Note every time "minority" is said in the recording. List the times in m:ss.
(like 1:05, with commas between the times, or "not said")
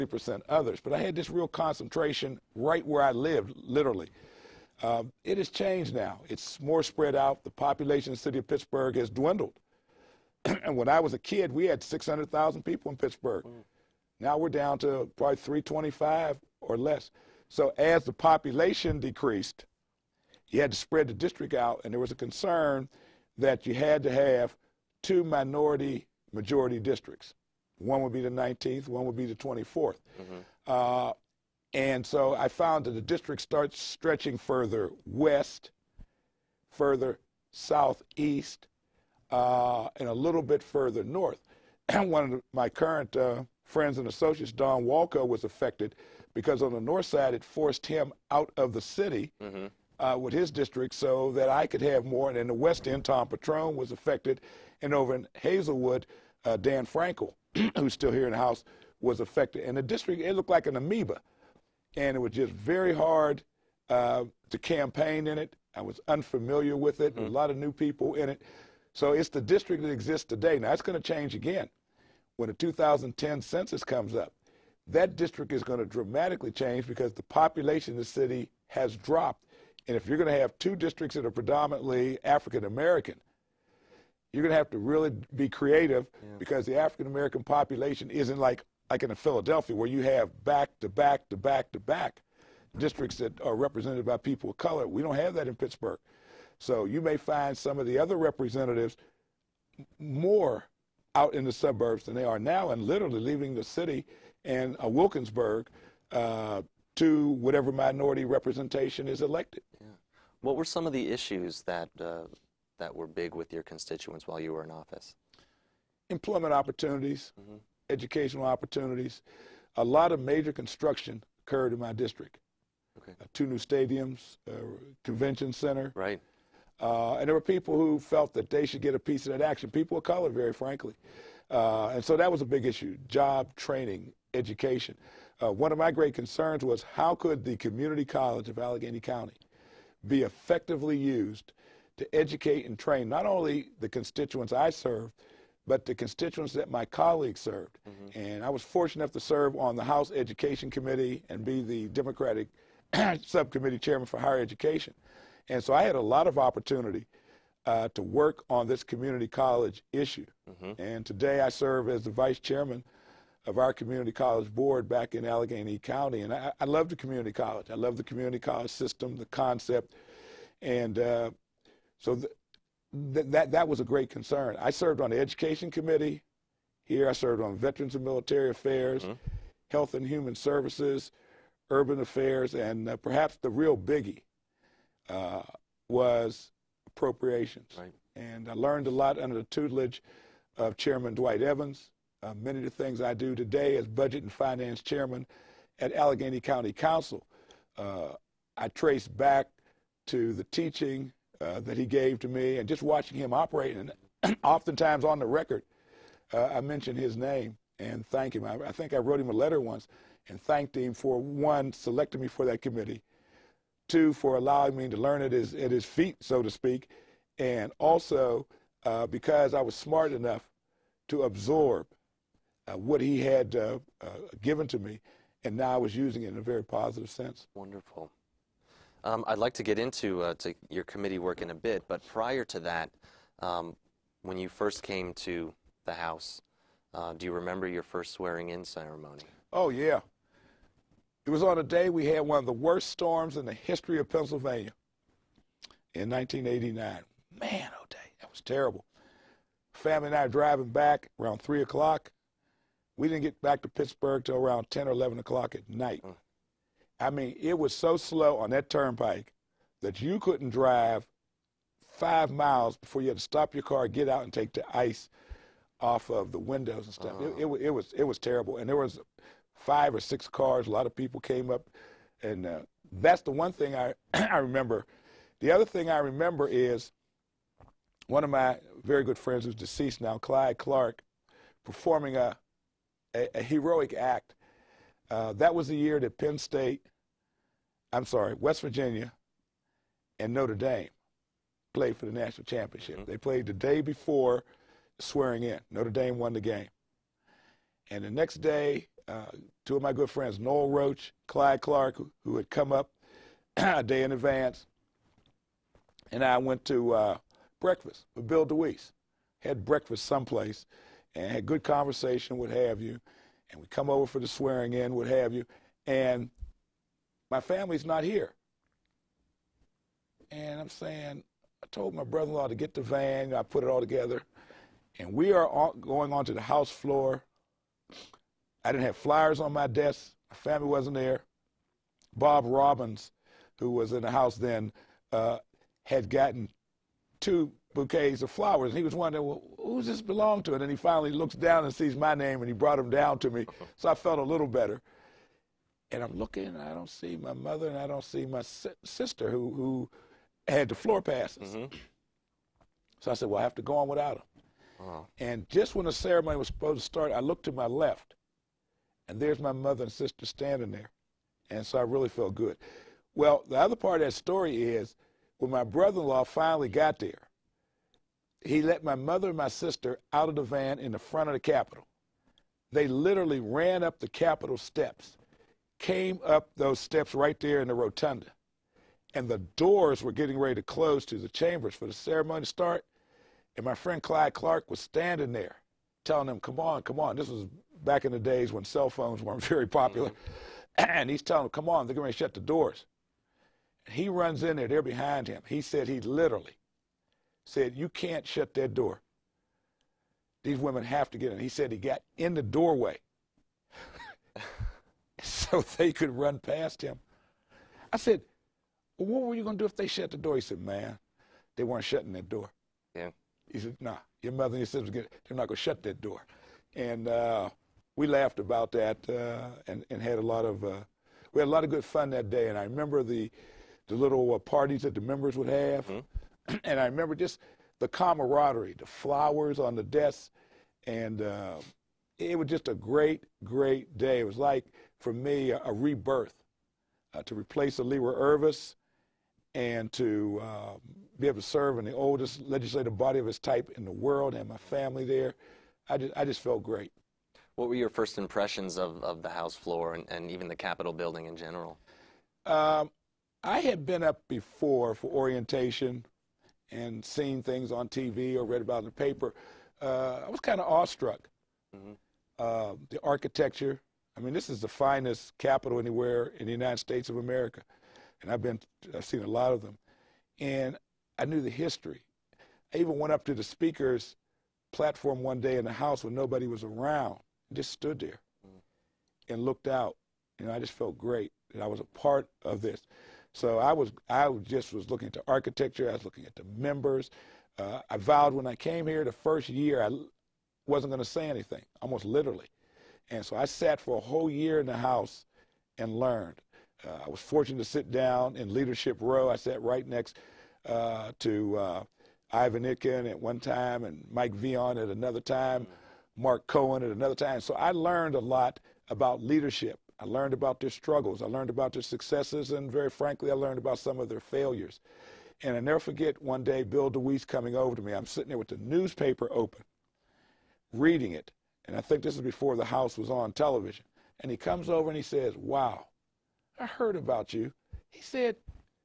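0:25, 1:47.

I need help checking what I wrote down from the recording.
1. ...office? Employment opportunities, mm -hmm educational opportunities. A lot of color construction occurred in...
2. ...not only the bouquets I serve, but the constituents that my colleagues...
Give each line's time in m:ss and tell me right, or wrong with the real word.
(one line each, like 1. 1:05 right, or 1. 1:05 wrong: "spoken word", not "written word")
1. 1:54 wrong: "major", not "color"
2. 2:23 wrong: "constituents", not "bouquets".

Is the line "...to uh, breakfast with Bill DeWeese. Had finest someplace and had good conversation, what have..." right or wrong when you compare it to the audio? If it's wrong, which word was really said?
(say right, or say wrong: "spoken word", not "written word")
wrong: "breakfast", not "finest".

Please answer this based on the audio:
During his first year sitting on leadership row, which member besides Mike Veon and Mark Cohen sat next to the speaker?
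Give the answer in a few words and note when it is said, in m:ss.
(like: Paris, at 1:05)
Ivan Itkin, at 8:22.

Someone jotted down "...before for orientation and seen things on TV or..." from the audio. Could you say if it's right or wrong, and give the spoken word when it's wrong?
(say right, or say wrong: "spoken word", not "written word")
right.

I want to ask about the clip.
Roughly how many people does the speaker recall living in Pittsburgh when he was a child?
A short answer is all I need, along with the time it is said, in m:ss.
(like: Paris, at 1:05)
600,000, at 0:11.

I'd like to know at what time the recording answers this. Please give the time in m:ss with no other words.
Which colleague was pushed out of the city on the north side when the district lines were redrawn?
0:44.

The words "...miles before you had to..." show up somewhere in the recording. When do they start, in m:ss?
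4:22.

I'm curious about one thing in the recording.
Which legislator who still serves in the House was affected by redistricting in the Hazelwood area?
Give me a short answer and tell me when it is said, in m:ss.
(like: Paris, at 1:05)
Dan Frankel, at 0:56.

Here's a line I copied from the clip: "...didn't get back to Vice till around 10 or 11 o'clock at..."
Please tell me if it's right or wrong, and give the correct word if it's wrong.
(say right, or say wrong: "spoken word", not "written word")
wrong: "Pittsburgh", not "Vice".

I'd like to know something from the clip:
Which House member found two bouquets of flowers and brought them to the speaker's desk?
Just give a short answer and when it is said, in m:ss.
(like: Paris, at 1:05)
Bob Robbins, at 5:32.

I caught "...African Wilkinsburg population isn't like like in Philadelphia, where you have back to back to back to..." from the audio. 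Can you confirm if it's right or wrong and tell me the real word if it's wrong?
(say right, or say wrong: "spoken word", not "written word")
wrong: "American", not "Wilkinsburg".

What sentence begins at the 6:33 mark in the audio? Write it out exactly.
And he runs in there, they're behind him.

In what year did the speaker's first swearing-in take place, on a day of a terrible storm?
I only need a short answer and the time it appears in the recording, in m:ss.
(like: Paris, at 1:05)
1989, at 4:06.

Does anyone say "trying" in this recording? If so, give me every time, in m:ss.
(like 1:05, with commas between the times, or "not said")
not said.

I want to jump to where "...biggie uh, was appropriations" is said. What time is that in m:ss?
3:03.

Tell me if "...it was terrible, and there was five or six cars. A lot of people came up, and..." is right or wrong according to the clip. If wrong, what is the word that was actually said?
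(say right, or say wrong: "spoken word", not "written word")
right.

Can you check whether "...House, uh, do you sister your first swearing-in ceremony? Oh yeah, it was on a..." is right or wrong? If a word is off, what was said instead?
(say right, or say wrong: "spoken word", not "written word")
wrong: "remember", not "sister".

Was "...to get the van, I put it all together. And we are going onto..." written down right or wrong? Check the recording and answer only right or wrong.
right.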